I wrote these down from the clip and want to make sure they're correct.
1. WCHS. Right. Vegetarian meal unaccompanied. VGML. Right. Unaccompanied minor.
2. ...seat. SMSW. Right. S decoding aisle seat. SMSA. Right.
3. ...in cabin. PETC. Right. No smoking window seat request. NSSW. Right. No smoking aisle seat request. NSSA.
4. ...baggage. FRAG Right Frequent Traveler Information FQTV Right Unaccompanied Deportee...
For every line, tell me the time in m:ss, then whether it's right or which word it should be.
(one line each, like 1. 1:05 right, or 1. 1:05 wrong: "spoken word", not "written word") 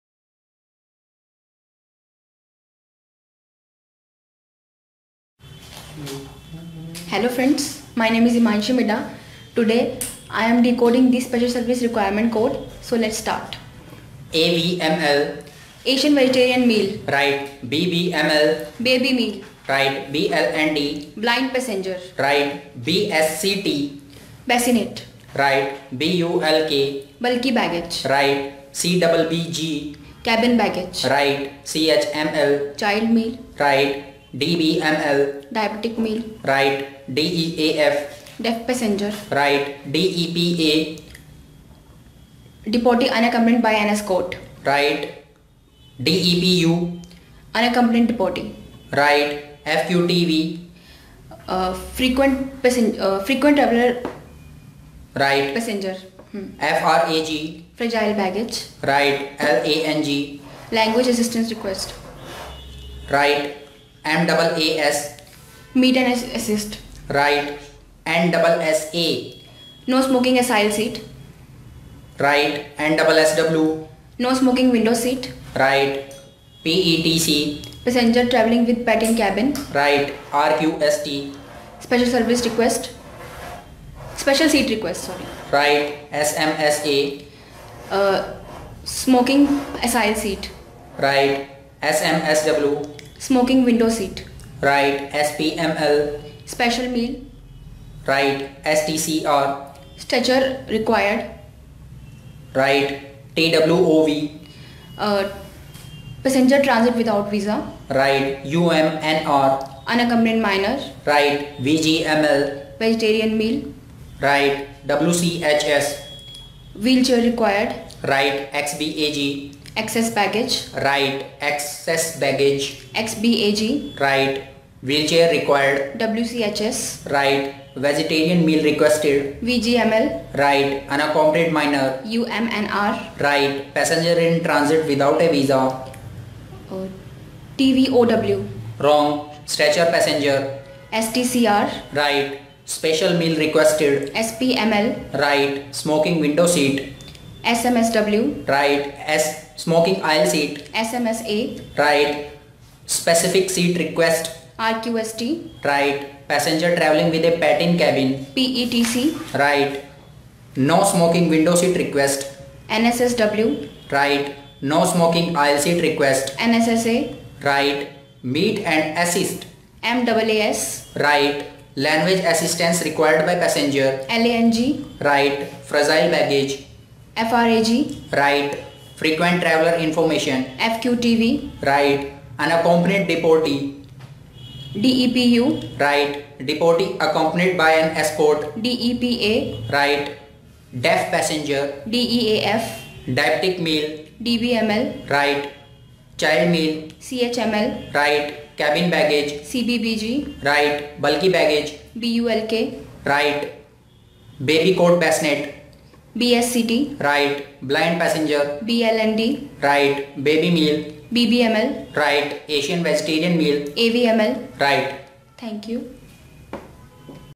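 1. 2:05 wrong: "requested", not "unaccompanied"
2. 2:26 wrong: "smoking", not "decoding"
3. 2:37 right
4. 2:56 right.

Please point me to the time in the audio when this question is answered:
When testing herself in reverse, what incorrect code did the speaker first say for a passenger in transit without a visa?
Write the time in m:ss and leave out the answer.
2:17.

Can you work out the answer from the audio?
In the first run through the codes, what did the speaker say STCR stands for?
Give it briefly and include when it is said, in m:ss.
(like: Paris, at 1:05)
Stretcher required, at 1:39.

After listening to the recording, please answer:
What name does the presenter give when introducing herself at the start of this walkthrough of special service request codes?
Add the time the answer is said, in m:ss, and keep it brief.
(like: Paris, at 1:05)
Himanshi Middha, at 0:08.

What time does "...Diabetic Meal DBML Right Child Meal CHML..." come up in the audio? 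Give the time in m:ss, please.
3:13.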